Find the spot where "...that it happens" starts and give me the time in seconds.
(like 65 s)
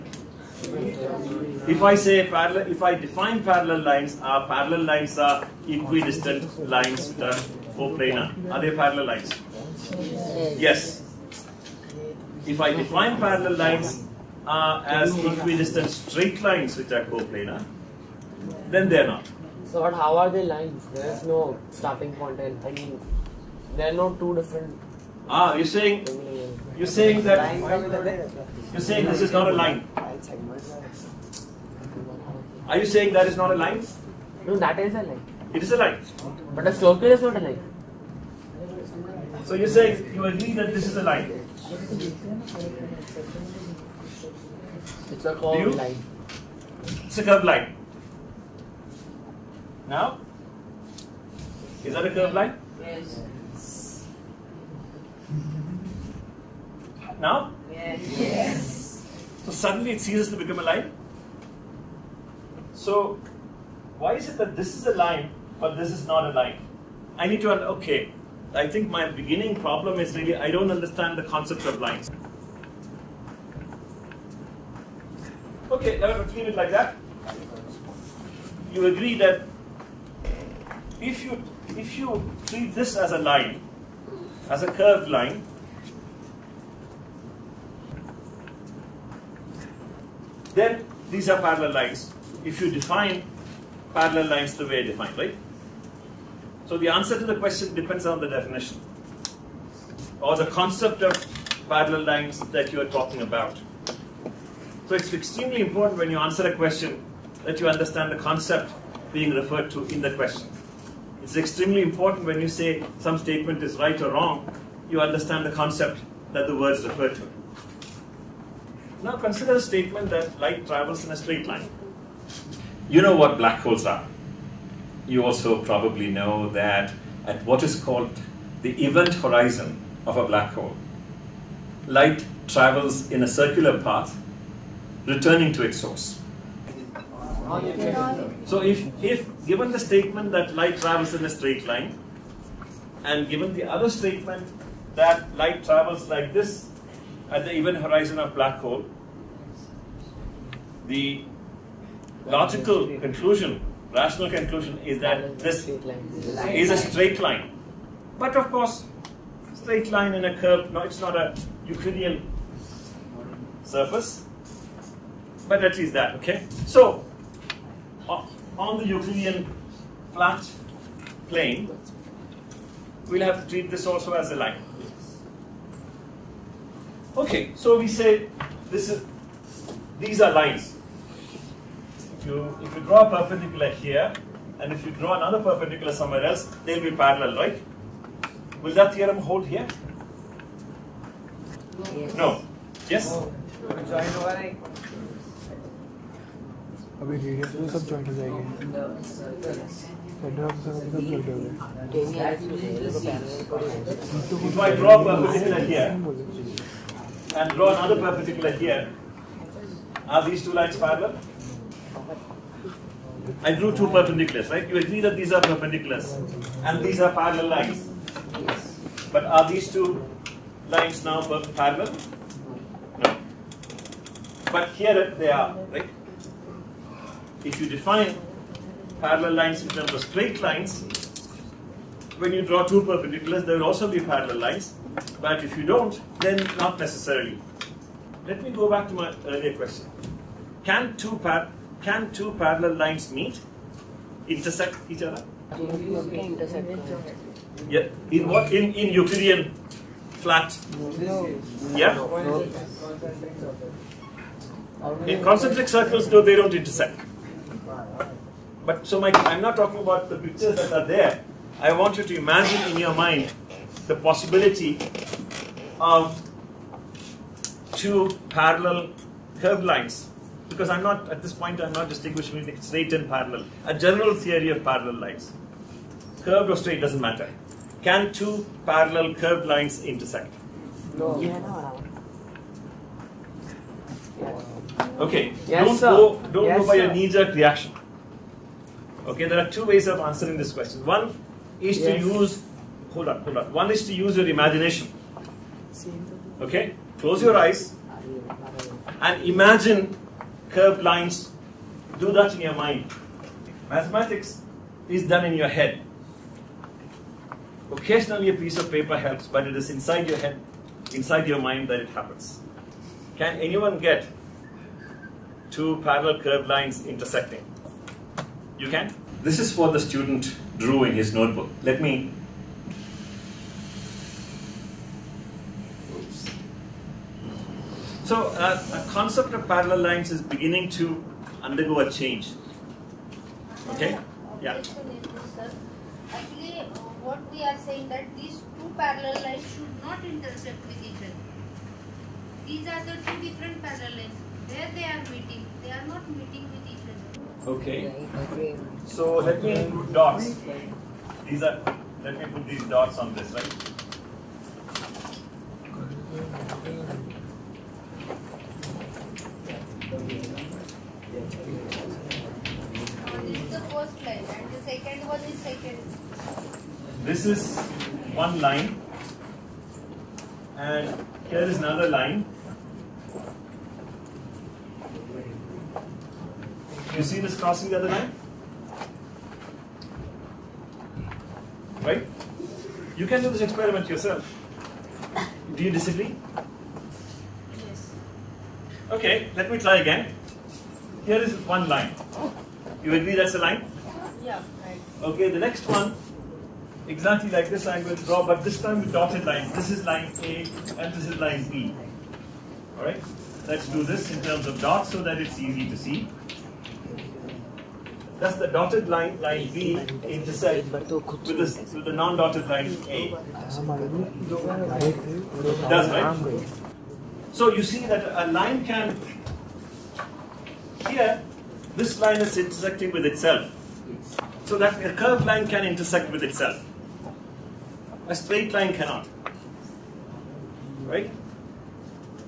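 311 s.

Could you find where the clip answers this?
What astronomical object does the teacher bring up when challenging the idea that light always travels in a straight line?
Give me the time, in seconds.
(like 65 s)
123 s.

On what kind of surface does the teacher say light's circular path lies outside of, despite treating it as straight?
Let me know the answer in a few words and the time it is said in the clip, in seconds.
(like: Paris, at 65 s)
Euclidean surface, at 161 s.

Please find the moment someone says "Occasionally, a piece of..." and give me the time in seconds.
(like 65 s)
307 s.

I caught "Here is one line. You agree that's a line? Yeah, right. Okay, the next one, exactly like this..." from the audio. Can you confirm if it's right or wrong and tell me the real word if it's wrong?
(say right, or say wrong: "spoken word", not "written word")
right.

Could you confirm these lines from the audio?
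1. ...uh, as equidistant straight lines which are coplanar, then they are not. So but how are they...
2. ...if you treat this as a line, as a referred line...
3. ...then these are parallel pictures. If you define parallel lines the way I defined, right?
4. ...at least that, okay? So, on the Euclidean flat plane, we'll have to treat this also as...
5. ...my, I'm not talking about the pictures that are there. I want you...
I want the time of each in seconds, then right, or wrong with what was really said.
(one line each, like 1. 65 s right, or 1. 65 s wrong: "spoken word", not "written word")
1. 14 s right
2. 81 s wrong: "curved", not "referred"
3. 90 s wrong: "lines", not "pictures"
4. 165 s right
5. 258 s right.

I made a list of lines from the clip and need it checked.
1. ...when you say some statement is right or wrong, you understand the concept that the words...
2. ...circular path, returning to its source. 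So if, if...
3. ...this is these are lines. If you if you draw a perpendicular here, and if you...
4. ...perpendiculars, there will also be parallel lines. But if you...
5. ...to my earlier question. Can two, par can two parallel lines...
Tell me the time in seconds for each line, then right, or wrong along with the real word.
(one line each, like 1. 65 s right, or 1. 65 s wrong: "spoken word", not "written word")
1. 112 s right
2. 133 s right
3. 178 s right
4. 232 s right
5. 238 s right.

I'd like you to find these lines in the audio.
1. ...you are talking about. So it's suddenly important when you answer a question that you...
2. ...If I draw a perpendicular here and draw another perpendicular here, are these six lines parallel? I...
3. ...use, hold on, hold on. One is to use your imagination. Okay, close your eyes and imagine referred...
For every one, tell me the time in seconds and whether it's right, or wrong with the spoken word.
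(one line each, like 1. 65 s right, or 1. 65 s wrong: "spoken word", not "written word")
1. 102 s wrong: "extremely", not "suddenly"
2. 204 s wrong: "two", not "six"
3. 292 s wrong: "curved", not "referred".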